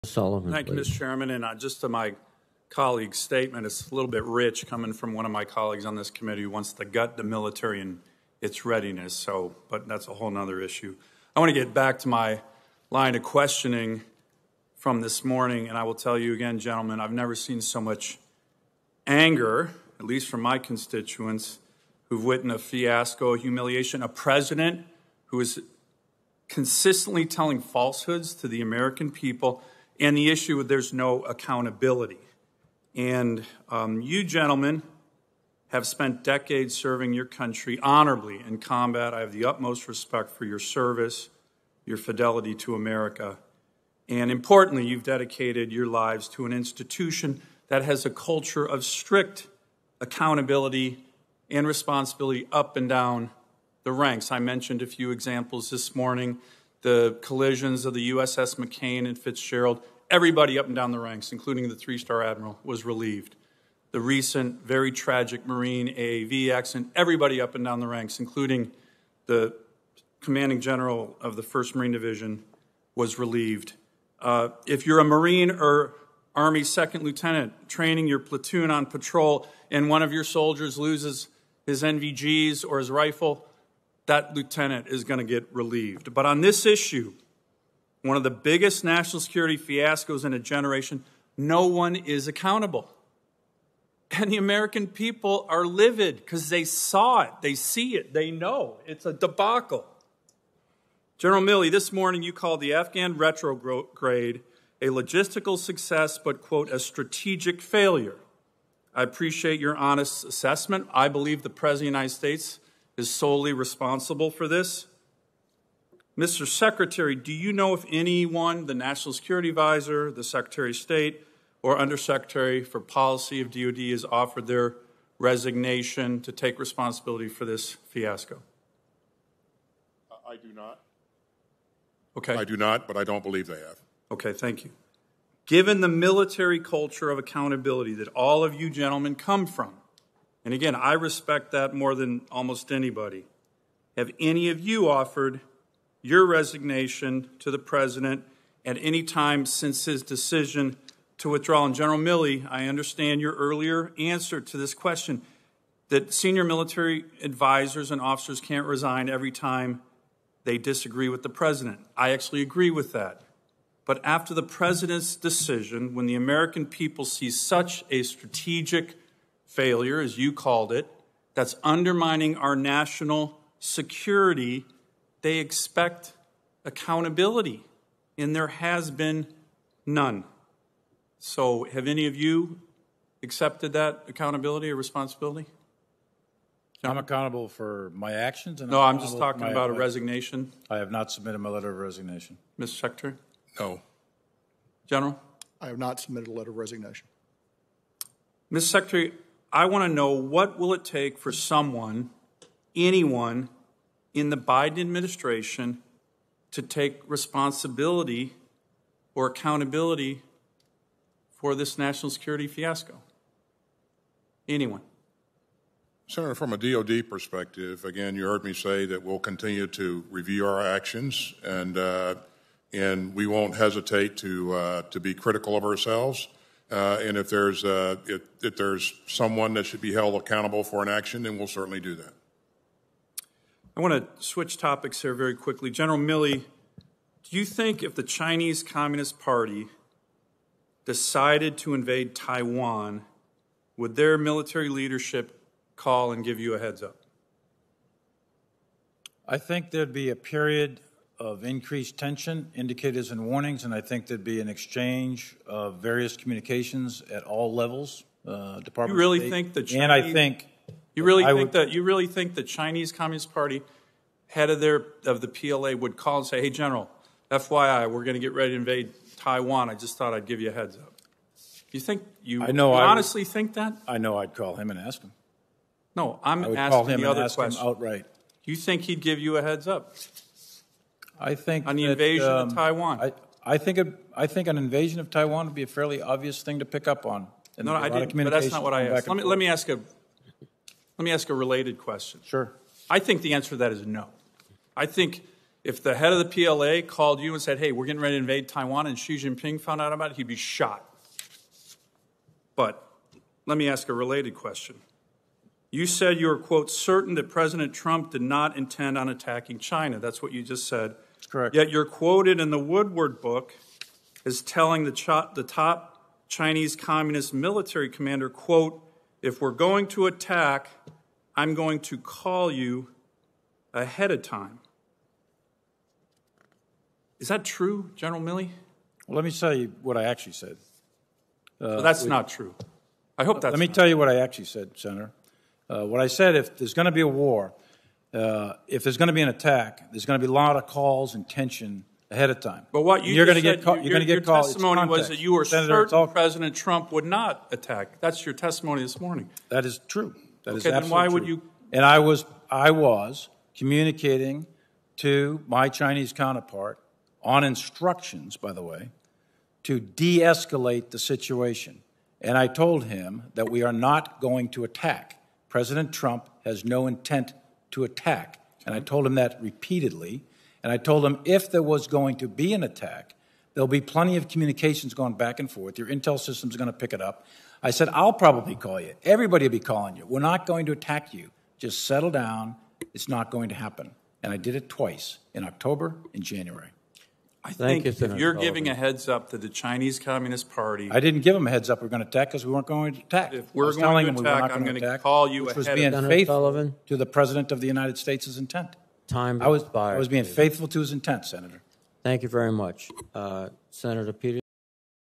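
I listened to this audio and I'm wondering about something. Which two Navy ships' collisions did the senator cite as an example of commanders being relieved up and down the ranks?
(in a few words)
USS McCain and Fitzgerald.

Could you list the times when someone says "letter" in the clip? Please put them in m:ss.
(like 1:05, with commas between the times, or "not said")
3:11, 3:16.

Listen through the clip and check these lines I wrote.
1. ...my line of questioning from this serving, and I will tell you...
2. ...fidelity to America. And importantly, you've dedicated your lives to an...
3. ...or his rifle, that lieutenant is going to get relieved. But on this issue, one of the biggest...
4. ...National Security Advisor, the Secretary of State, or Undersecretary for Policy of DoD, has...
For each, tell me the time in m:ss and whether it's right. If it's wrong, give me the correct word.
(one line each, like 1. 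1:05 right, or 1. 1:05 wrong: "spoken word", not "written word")
1. 0:12 wrong: "morning", not "serving"
2. 0:41 right
3. 1:22 right
4. 1:58 right.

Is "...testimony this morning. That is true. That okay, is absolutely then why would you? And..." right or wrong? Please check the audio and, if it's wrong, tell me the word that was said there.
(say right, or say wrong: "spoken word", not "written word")
right.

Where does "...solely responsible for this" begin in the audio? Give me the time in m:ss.
1:53.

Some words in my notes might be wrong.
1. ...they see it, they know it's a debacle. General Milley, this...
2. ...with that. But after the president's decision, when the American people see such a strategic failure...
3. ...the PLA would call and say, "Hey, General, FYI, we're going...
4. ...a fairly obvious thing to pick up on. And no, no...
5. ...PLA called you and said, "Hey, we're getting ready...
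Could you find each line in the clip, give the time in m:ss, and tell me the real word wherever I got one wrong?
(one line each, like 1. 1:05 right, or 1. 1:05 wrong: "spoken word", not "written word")
1. 1:37 right
2. 2:42 right
3. 4:25 right
4. 4:45 right
5. 4:56 right.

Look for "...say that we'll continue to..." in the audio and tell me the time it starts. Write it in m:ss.
3:38.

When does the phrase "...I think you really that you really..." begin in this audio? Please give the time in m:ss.
4:19.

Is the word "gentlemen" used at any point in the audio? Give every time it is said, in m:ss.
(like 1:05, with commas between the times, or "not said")
0:16, 0:34, 2:18.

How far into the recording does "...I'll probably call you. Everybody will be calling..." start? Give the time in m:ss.
6:17.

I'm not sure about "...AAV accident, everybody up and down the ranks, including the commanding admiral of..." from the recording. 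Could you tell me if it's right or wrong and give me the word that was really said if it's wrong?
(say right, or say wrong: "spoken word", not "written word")
wrong: "general", not "admiral".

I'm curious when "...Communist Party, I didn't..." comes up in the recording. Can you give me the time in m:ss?
6:29.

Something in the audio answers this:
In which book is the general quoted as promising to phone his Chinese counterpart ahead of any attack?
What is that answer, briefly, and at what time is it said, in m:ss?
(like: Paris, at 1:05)
the Woodward book, at 5:12.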